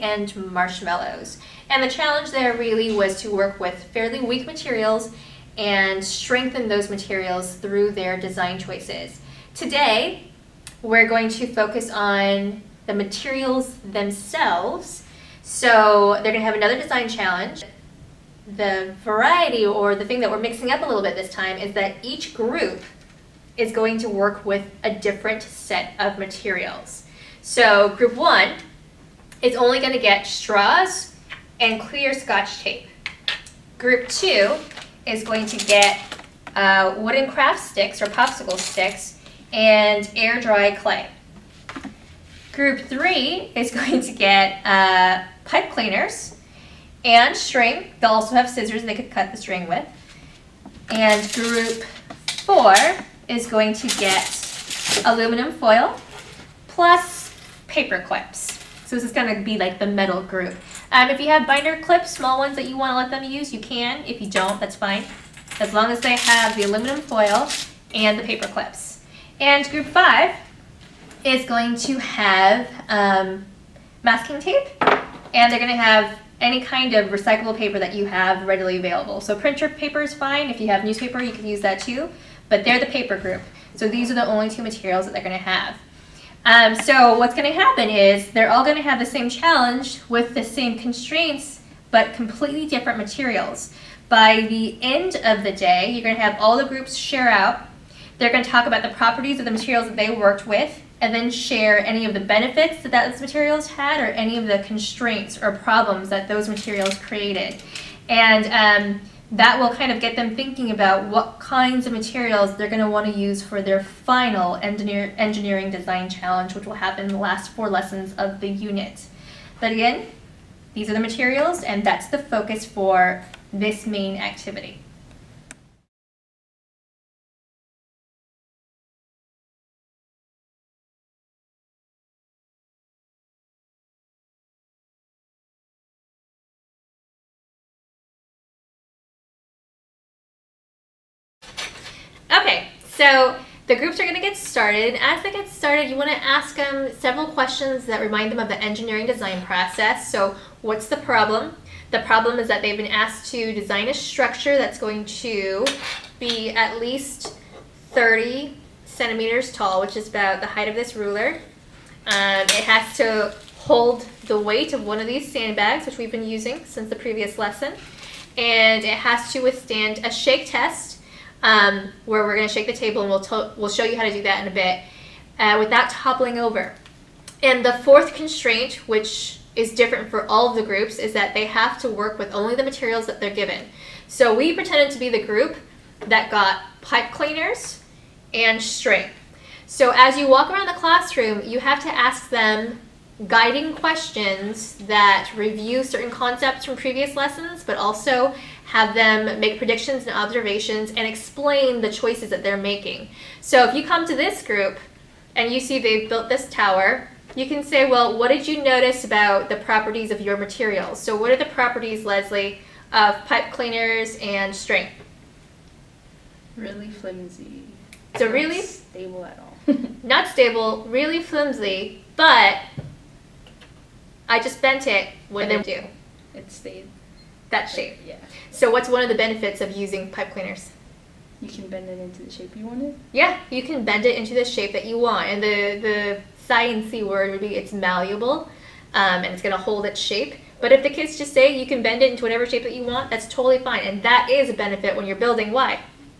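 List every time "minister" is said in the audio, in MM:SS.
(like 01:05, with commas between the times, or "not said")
not said.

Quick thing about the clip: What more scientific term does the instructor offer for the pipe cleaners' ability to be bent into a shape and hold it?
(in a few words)
malleable.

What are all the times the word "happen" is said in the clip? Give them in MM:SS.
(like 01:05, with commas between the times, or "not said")
01:27, 01:56.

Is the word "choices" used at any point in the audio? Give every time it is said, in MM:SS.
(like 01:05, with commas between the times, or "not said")
00:08, 03:21.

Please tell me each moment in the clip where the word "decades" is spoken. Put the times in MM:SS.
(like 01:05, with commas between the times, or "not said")
not said.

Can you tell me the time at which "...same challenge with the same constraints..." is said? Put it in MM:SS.
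01:29.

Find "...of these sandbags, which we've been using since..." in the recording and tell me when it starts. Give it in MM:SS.
02:44.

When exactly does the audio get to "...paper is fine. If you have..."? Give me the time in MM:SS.
01:19.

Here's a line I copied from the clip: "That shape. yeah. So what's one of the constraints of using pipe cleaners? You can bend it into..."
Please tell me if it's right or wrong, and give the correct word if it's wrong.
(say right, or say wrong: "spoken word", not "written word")
wrong: "benefits", not "constraints".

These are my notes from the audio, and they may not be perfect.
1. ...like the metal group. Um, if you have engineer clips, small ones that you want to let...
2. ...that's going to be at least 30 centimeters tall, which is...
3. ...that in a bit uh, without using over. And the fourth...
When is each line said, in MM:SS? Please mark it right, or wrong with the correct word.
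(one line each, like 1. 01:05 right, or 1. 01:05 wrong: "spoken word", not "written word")
1. 00:59 wrong: "binder", not "engineer"
2. 02:34 right
3. 02:54 wrong: "toppling", not "using".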